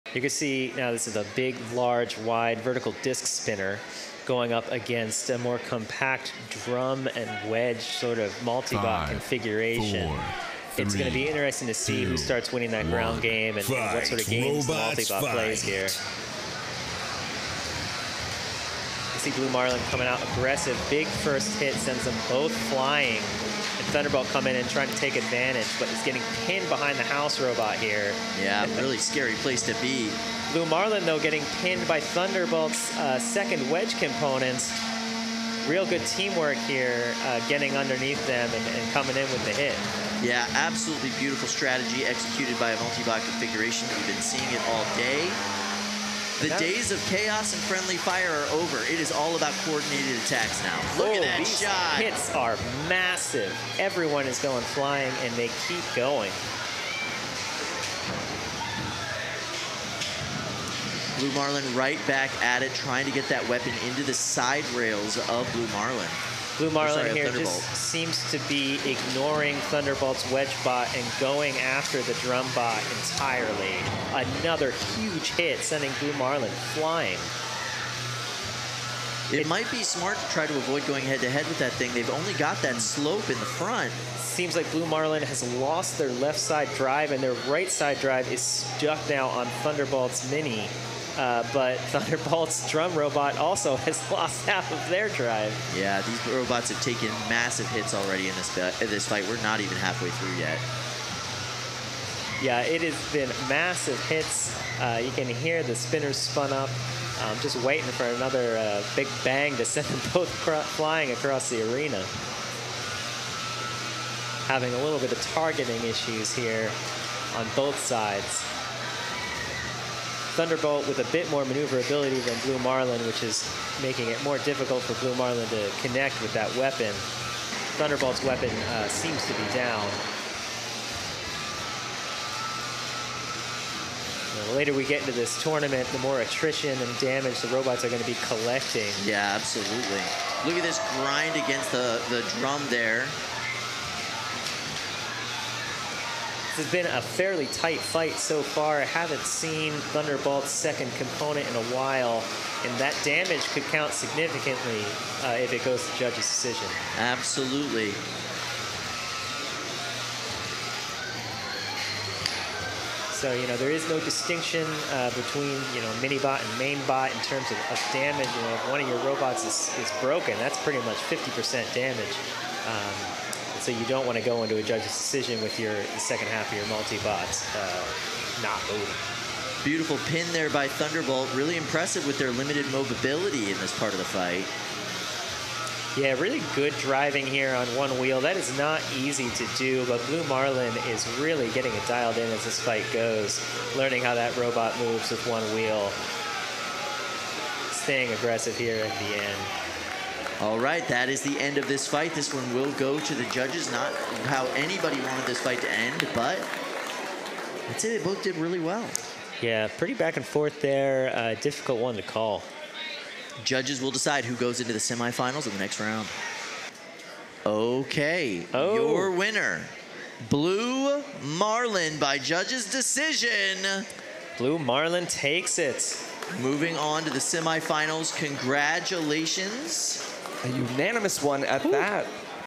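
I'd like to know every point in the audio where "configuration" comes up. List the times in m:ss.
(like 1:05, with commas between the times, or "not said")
0:09, 0:43.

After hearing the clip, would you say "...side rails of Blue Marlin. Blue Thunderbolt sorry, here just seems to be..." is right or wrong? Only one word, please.
wrong.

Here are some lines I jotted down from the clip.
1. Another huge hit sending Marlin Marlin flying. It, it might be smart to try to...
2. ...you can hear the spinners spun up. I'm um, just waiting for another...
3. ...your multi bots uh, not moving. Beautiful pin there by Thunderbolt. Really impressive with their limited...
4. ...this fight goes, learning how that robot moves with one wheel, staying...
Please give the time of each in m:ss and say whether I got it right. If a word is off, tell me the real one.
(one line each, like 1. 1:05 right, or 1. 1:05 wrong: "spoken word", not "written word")
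1. 1:14 wrong: "Blue", not "Marlin"
2. 1:45 right
3. 2:56 right
4. 3:12 right.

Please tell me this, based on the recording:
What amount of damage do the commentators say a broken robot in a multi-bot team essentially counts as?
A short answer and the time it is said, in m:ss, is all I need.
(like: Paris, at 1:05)
50%, at 2:50.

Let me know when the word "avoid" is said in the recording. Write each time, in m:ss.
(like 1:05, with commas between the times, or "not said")
1:20.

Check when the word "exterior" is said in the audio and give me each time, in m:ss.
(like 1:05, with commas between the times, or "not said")
not said.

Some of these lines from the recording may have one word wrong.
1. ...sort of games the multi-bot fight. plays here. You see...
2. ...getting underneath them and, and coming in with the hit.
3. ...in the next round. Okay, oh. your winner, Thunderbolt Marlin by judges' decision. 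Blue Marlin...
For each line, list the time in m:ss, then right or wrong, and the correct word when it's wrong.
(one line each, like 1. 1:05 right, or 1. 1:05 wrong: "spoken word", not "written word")
1. 0:14 right
2. 0:37 right
3. 3:35 wrong: "Blue", not "Thunderbolt".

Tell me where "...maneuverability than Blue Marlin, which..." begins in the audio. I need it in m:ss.
2:01.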